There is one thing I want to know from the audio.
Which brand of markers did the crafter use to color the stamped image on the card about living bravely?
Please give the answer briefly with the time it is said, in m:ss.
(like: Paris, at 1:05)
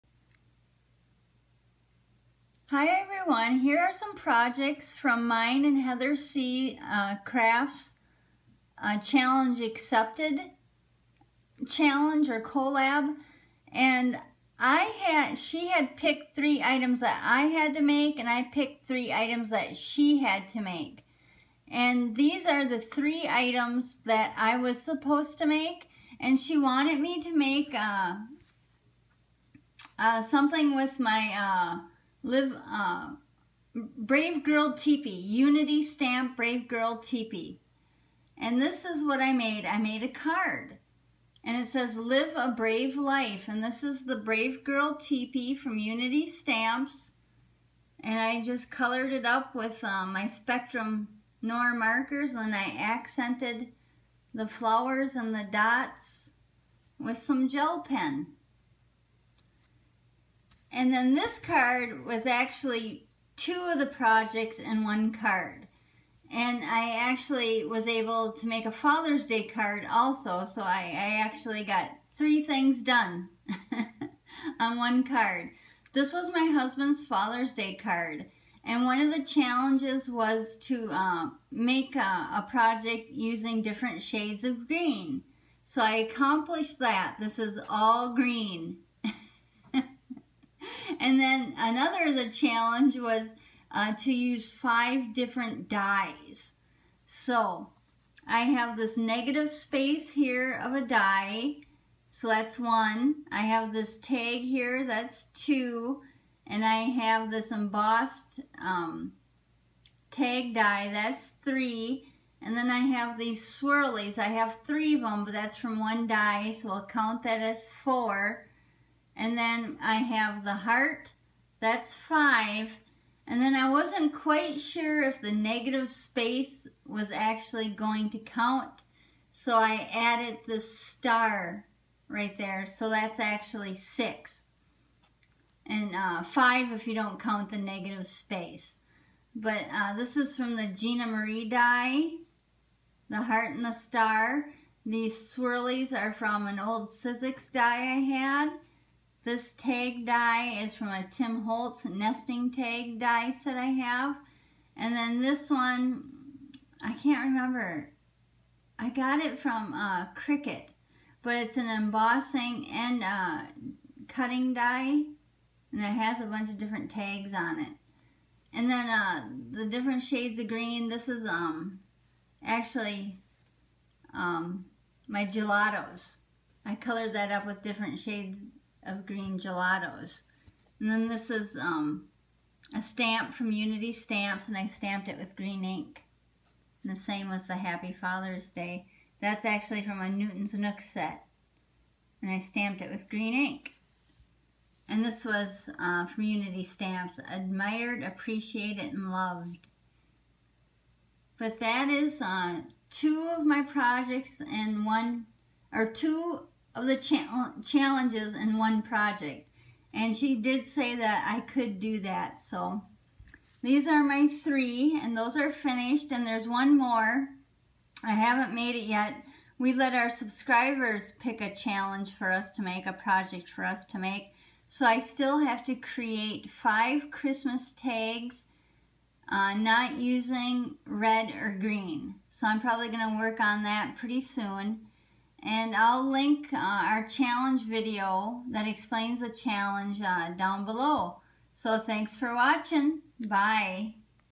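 Spectrum Noir, at 0:50.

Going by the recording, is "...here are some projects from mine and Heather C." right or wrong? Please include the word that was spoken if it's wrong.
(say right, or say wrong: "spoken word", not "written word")
right.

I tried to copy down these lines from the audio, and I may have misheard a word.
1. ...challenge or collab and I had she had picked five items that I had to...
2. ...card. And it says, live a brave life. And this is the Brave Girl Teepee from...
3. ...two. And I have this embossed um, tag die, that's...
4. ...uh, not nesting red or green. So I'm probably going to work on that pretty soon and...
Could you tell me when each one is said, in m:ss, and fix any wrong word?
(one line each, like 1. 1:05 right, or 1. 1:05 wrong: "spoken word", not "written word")
1. 0:11 wrong: "three", not "five"
2. 0:40 right
3. 1:45 right
4. 3:49 wrong: "using", not "nesting".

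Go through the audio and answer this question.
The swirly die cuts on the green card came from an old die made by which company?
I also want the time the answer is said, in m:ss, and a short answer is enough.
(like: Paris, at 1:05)
Sizzix, at 2:26.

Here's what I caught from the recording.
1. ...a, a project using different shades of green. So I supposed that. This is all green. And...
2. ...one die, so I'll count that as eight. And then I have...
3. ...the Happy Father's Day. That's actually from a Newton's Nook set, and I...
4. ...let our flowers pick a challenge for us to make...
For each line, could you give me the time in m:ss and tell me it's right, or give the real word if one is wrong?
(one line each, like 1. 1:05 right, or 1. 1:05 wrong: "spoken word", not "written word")
1. 1:21 wrong: "accomplished", not "supposed"
2. 1:55 wrong: "four", not "eight"
3. 3:07 right
4. 3:39 wrong: "subscribers", not "flowers".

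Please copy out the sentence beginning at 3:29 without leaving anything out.
And she did say that I could do that.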